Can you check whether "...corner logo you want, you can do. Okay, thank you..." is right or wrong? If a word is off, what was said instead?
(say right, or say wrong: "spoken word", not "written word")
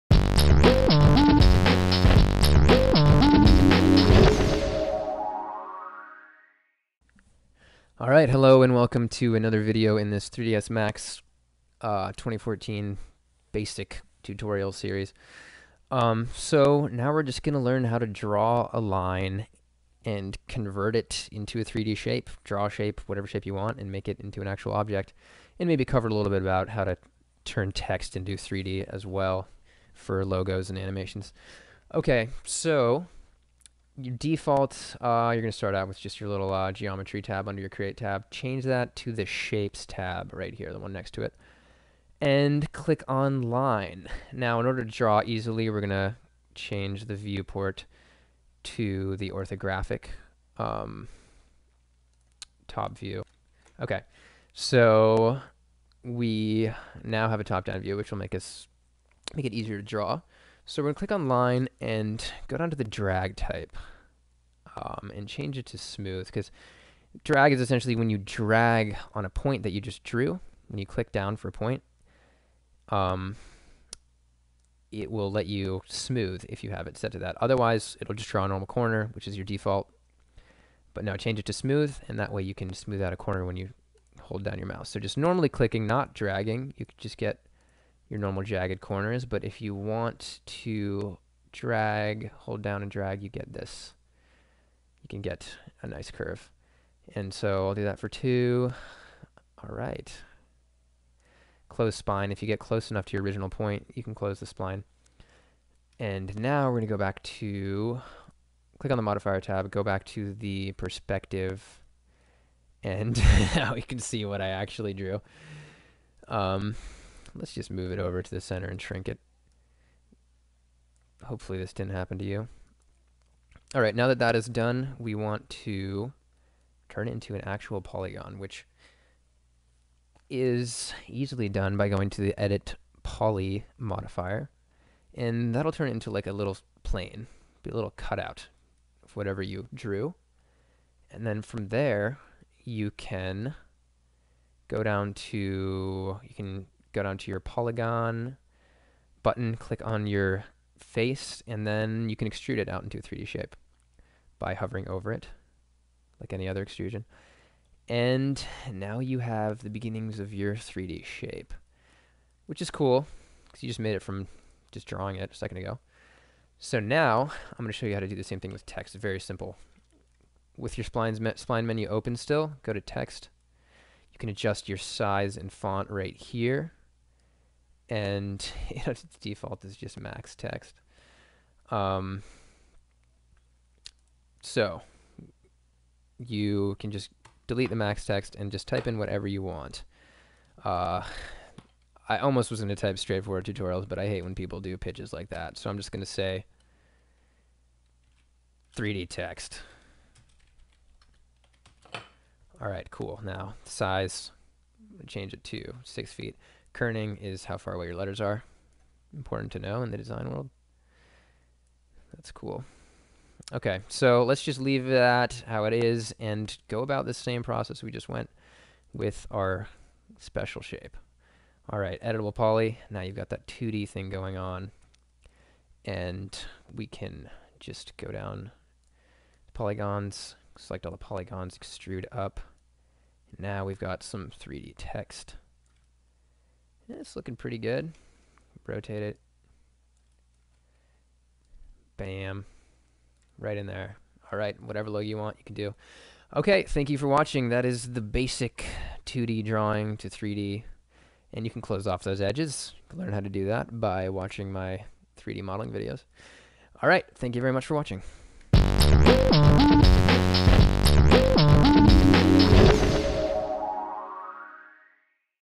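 wrong: "whatever", not "corner".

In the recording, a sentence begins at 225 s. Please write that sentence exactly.
And we can just go down polygons, select all the polygons, extrude up.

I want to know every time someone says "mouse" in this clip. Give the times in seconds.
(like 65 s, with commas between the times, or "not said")
84 s.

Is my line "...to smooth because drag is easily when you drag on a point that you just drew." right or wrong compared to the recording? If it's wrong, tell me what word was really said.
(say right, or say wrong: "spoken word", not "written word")
wrong: "essentially", not "easily".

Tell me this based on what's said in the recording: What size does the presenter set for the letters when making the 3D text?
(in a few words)
6 feet.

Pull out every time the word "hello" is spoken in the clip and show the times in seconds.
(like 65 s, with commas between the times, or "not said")
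8 s.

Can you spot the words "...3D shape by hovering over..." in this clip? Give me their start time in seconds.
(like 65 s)
153 s.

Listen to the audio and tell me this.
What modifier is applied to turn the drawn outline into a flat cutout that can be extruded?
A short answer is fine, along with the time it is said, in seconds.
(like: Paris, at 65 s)
edit poly, at 132 s.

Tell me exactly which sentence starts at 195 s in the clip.
So I'm just going to say 3D text.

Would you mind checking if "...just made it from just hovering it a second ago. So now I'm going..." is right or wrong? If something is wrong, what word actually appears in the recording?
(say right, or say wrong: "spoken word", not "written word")
wrong: "drawing", not "hovering".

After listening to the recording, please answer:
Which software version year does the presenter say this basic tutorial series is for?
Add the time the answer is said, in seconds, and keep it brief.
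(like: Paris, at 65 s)
2014, at 12 s.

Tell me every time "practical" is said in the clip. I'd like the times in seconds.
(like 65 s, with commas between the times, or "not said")
not said.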